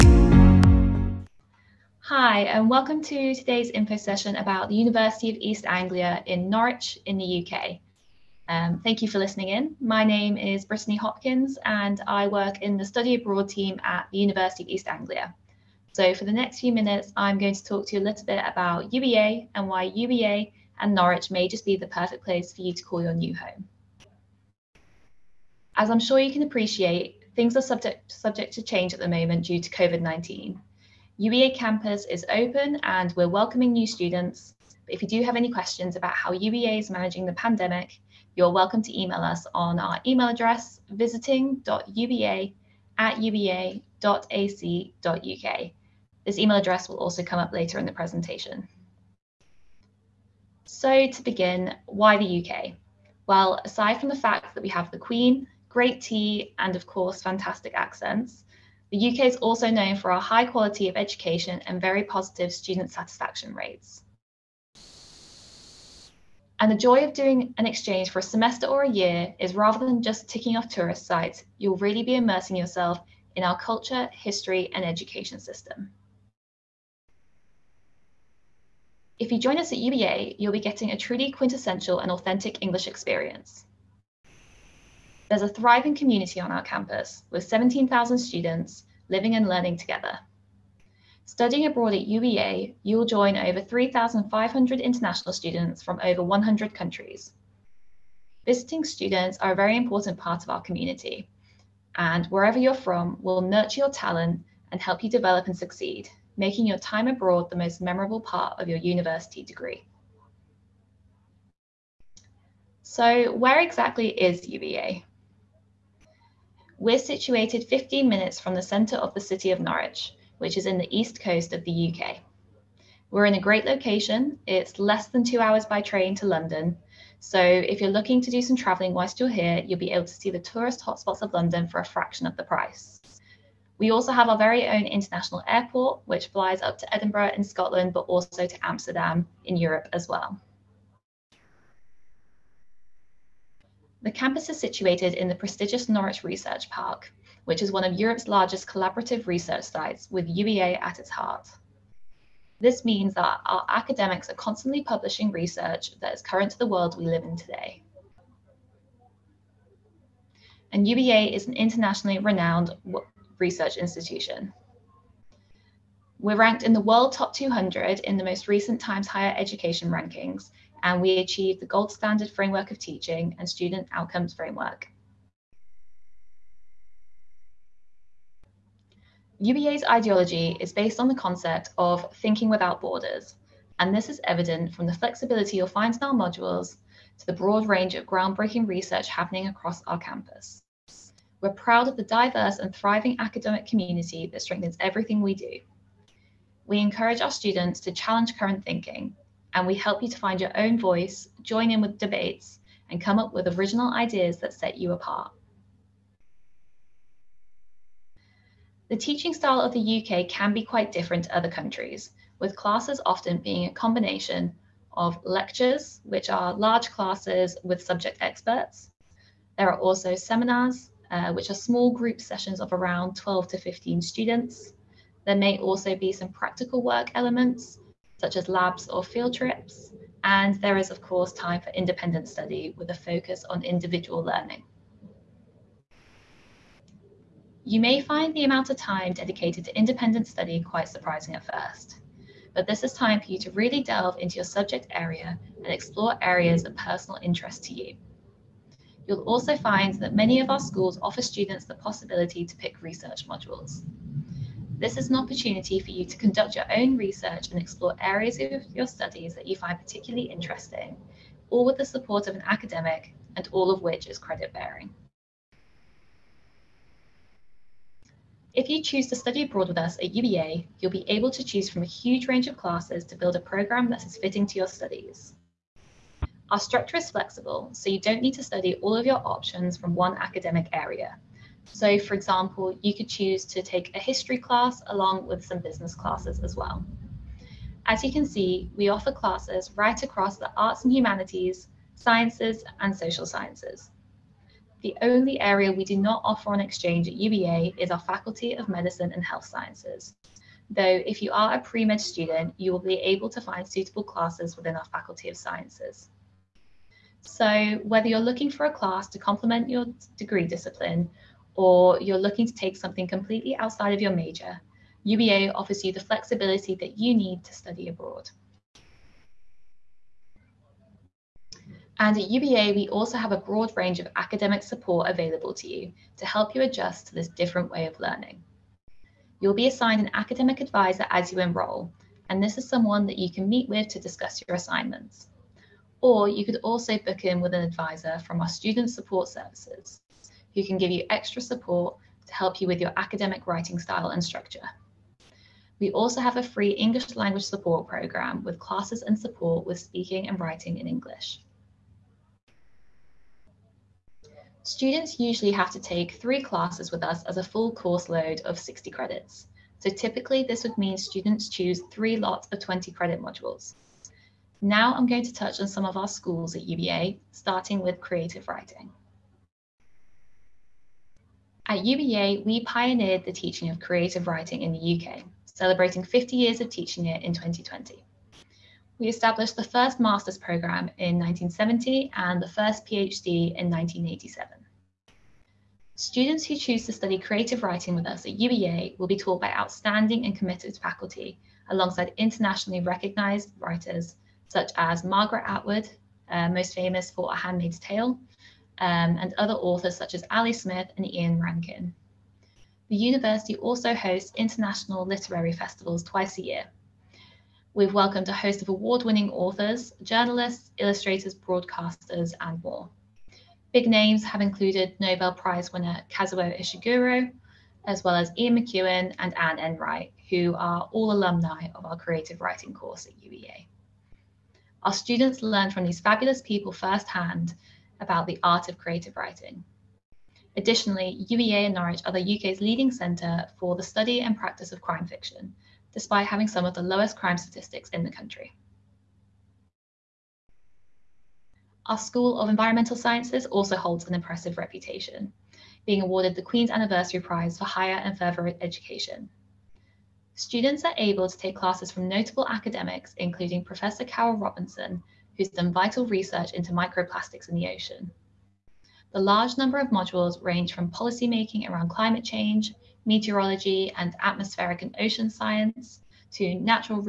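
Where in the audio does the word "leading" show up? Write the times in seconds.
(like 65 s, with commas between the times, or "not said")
432 s.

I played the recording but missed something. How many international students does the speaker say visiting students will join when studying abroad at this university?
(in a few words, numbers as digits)
3,500.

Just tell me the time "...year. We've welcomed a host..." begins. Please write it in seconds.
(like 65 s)
406 s.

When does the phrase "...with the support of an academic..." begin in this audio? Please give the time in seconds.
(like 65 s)
261 s.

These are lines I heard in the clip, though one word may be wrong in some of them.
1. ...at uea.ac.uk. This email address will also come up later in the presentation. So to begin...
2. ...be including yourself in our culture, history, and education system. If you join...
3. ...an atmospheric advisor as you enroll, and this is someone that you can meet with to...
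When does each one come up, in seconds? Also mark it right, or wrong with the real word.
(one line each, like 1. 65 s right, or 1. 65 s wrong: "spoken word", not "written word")
1. 42 s right
2. 72 s wrong: "immersing", not "including"
3. 330 s wrong: "academic", not "atmospheric".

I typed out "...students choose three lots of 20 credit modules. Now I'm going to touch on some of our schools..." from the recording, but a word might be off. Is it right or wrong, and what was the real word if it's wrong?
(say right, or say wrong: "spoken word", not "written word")
right.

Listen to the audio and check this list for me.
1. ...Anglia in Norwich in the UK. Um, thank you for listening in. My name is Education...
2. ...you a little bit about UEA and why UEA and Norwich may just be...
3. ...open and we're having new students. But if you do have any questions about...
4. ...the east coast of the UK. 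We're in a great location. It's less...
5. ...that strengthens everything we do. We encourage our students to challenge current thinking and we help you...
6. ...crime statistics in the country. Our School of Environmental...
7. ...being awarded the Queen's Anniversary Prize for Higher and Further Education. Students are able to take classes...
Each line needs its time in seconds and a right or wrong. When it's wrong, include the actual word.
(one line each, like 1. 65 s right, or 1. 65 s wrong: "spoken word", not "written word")
1. 5 s wrong: "Brittany", not "Education"
2. 17 s right
3. 32 s wrong: "welcoming", not "having"
4. 120 s right
5. 194 s right
6. 437 s right
7. 445 s right.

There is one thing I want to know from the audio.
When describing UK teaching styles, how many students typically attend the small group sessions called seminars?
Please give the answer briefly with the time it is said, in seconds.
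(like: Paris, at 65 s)
12 to 15, at 223 s.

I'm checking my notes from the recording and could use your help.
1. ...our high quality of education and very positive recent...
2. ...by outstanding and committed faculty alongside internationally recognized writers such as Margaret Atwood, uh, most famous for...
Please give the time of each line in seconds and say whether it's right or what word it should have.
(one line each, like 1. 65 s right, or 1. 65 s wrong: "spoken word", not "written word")
1. 60 s wrong: "student", not "recent"
2. 389 s right.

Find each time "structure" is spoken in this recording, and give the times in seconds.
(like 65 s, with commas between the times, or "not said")
276 s, 344 s.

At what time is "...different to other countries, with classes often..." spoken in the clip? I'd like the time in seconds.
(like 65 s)
210 s.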